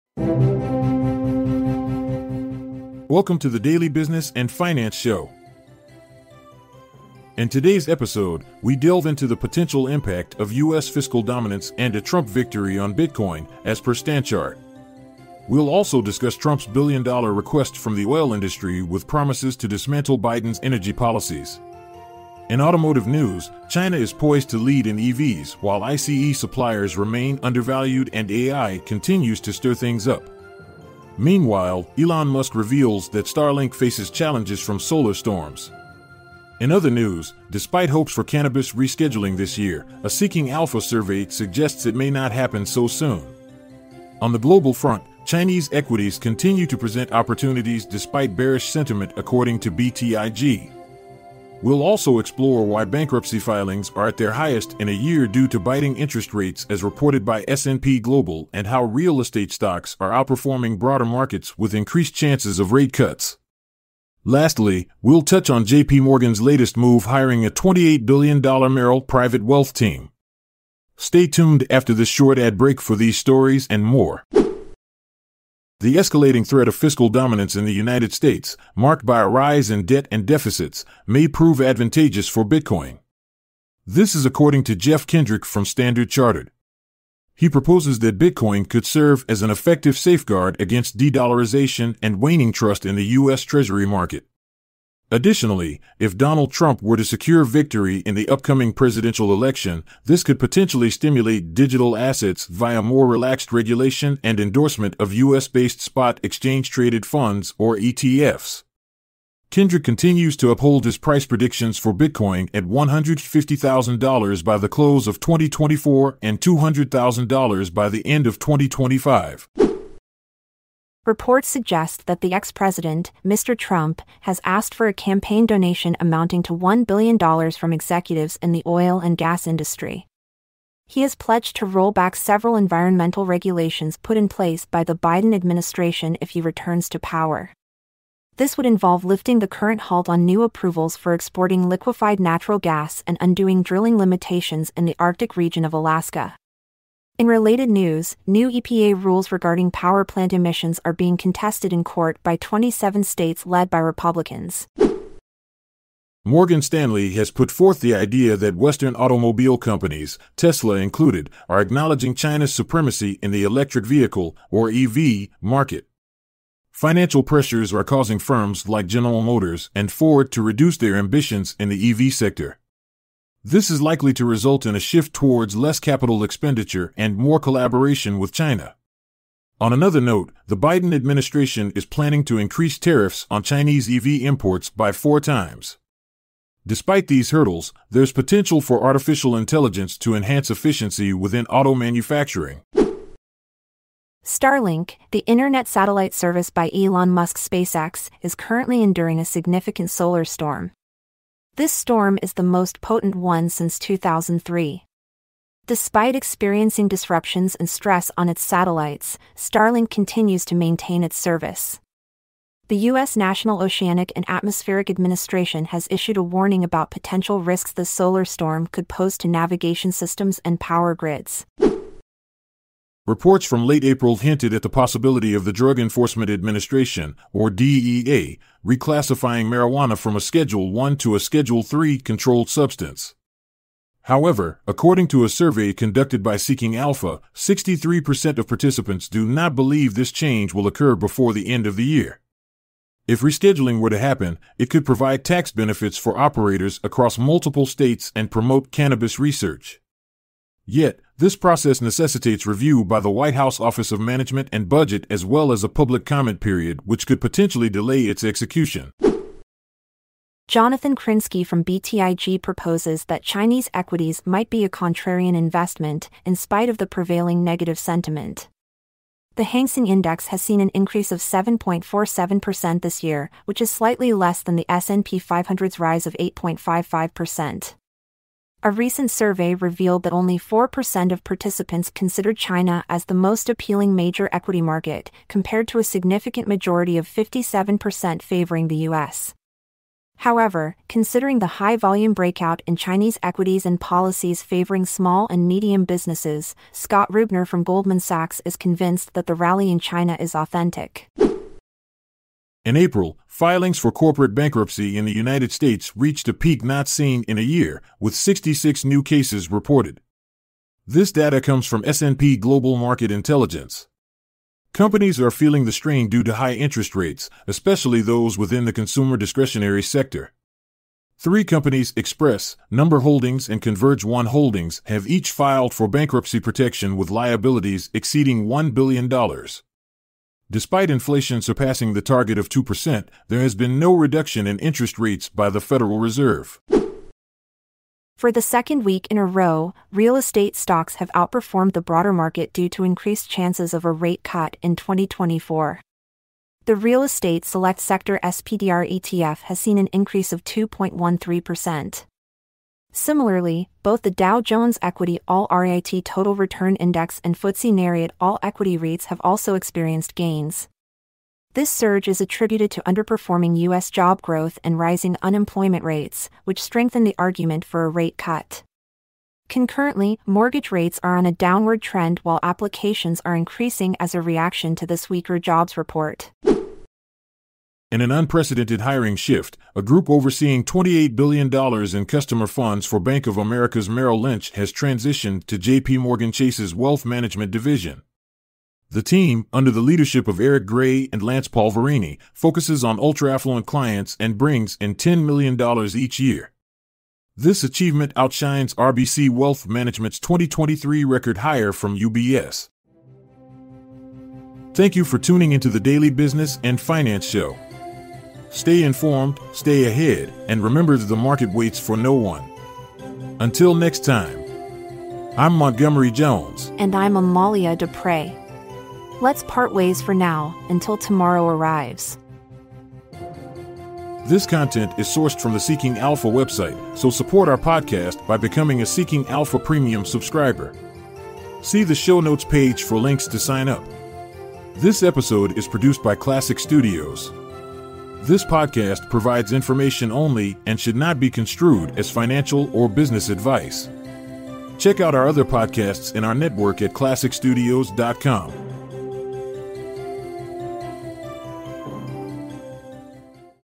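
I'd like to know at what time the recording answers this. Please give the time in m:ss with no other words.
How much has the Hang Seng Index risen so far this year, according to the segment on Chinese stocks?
4:31.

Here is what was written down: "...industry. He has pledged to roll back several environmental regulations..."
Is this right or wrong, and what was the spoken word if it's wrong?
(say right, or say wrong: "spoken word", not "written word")
right.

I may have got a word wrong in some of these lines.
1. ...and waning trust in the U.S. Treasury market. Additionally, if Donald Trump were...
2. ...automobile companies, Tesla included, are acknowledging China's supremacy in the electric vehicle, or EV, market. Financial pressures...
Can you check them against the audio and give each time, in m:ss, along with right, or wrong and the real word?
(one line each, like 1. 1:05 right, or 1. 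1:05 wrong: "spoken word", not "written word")
1. 1:31 right
2. 2:38 right.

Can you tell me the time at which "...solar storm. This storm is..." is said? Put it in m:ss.
3:19.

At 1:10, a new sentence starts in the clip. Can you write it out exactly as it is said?
Stay tuned after this short ad break for these stories and more.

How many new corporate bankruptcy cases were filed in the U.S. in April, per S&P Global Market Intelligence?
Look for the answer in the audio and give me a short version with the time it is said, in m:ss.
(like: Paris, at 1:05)
66, at 5:08.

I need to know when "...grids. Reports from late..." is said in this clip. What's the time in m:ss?
3:40.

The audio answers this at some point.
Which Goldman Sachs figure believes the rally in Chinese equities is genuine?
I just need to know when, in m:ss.
4:56.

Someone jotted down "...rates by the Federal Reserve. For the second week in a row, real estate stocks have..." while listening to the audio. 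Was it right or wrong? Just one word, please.
right.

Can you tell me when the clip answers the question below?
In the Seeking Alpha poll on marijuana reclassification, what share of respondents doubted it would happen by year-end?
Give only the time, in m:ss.
3:57.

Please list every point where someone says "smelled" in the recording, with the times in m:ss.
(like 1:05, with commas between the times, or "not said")
not said.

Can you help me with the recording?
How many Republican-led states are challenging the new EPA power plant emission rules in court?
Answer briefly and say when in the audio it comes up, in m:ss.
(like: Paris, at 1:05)
27, at 2:32.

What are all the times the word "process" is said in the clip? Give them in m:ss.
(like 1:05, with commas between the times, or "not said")
4:11.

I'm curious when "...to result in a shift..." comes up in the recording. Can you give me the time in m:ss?
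2:54.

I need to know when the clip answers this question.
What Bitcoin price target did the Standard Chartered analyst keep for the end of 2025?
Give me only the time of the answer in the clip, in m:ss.
1:56.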